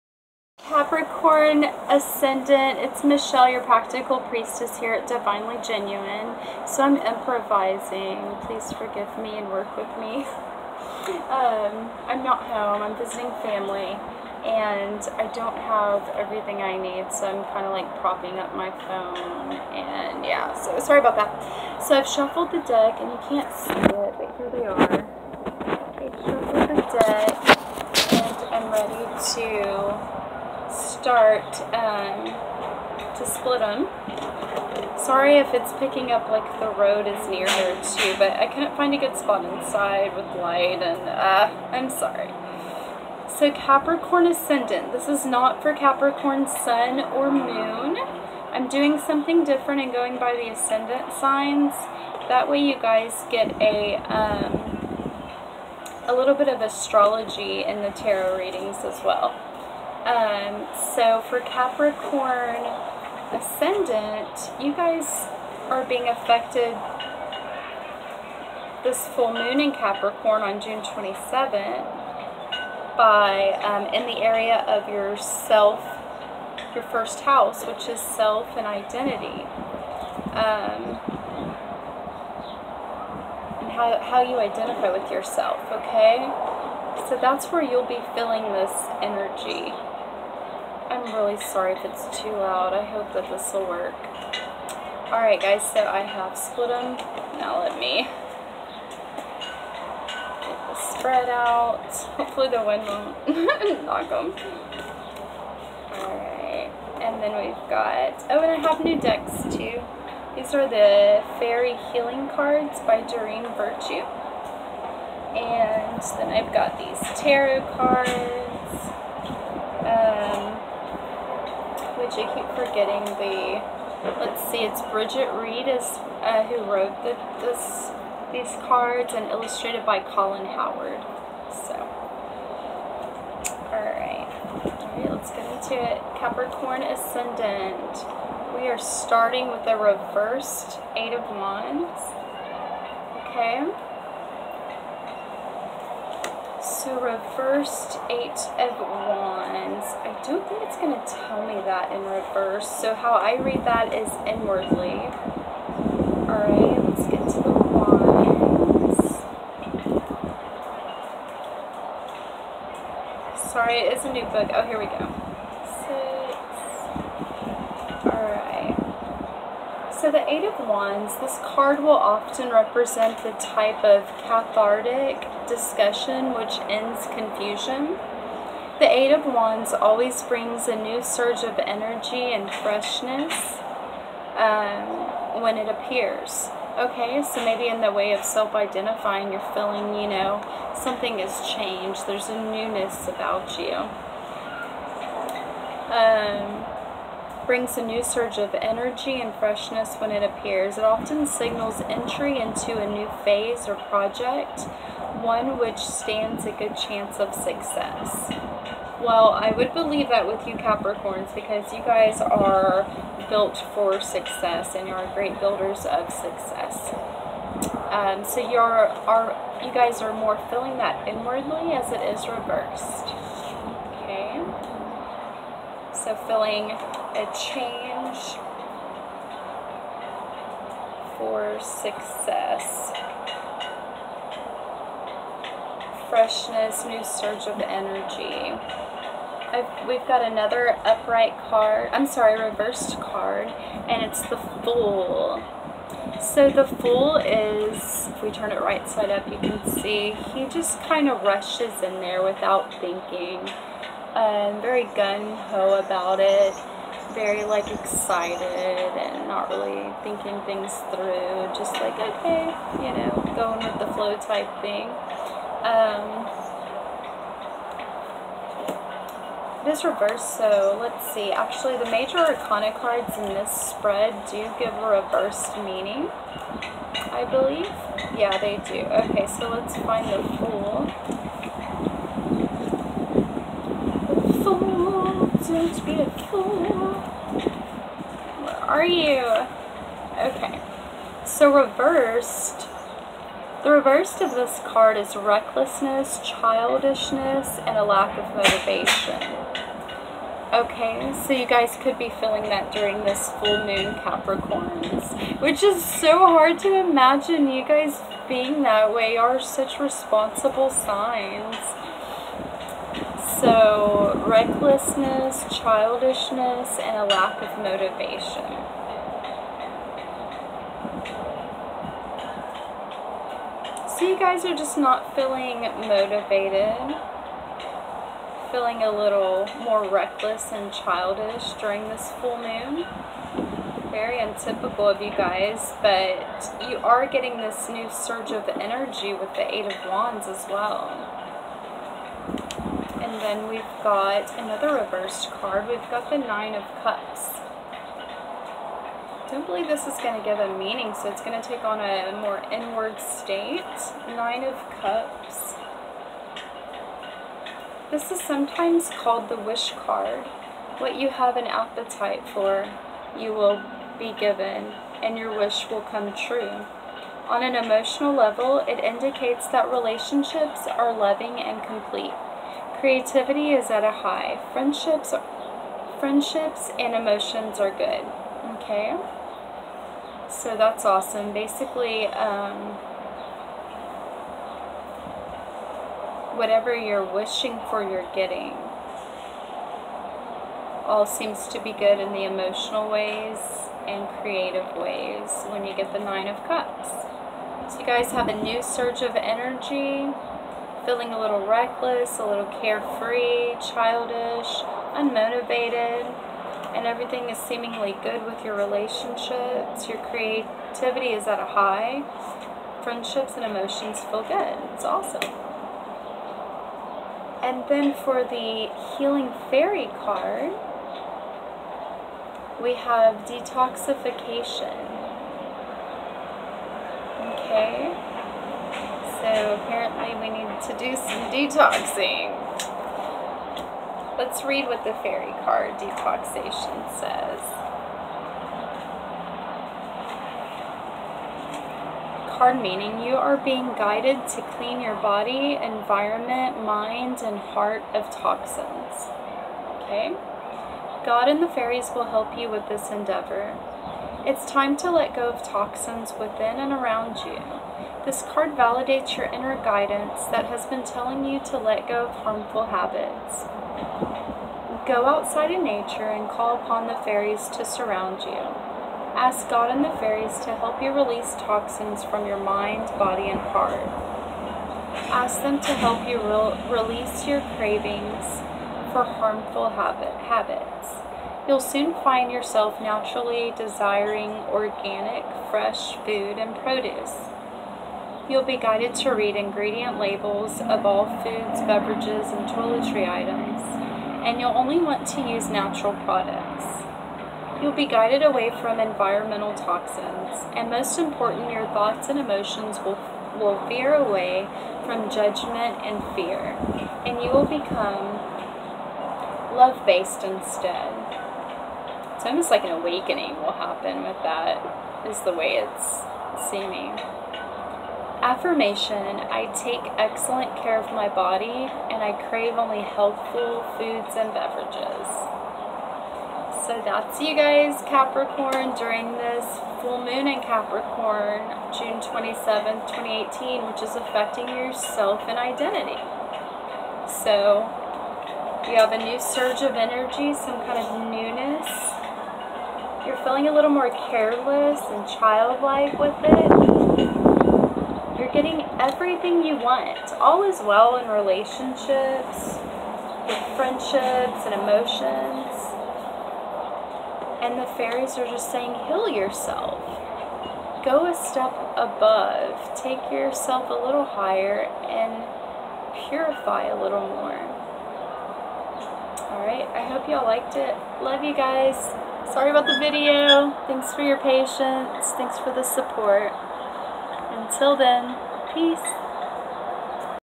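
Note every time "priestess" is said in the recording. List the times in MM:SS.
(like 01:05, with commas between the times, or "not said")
00:04.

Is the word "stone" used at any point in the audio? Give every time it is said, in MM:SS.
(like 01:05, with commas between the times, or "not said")
not said.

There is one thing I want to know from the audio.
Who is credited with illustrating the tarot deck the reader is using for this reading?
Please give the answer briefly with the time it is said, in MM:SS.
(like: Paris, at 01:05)
Colin Howard, at 02:09.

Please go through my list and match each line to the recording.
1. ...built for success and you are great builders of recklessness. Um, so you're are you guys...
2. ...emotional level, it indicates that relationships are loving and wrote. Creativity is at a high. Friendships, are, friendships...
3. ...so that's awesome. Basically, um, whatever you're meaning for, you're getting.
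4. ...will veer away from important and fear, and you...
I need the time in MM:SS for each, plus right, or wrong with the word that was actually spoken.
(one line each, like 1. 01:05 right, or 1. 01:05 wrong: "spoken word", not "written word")
1. 03:33 wrong: "success", not "recklessness"
2. 06:07 wrong: "complete", not "wrote"
3. 06:20 wrong: "wishing", not "meaning"
4. 08:23 wrong: "judgment", not "important".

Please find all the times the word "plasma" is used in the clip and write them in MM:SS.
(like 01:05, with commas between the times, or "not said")
not said.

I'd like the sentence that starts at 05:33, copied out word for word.
Very untypical of you guys, but you are getting this new surge of energy with the Eight of Wands as well.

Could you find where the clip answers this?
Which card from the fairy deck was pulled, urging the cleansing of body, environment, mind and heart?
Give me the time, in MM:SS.
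07:03.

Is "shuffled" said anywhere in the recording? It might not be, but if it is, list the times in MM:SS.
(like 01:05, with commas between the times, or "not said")
00:22, 00:26.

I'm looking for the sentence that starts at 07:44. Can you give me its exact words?
Go outside in nature and call upon the fairies to surround you.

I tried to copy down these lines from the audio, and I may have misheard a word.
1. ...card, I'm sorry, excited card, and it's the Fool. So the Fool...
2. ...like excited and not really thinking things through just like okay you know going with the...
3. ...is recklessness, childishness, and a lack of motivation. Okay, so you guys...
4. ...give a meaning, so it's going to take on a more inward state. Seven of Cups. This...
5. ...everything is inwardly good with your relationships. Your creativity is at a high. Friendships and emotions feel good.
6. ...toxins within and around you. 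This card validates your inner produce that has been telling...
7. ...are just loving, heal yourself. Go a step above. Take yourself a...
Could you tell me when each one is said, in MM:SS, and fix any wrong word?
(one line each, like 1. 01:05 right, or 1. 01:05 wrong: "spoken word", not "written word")
1. 04:01 wrong: "reversed", not "excited"
2. 04:17 right
3. 04:54 right
4. 05:50 wrong: "Nine", not "Seven"
5. 06:46 wrong: "seemingly", not "inwardly"
6. 07:35 wrong: "guidance", not "produce"
7. 09:18 wrong: "saying", not "loving".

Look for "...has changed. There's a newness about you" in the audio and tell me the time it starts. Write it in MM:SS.
03:11.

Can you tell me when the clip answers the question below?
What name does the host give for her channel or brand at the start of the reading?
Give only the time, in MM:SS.
00:05.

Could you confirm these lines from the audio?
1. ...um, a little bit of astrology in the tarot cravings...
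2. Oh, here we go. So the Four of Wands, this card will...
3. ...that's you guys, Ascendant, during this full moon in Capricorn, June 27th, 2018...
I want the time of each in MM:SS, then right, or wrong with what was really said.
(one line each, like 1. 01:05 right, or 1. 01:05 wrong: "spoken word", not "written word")
1. 00:54 wrong: "readings", not "cravings"
2. 02:44 wrong: "Eight", not "Four"
3. 08:46 wrong: "Capricorn", not "Ascendant".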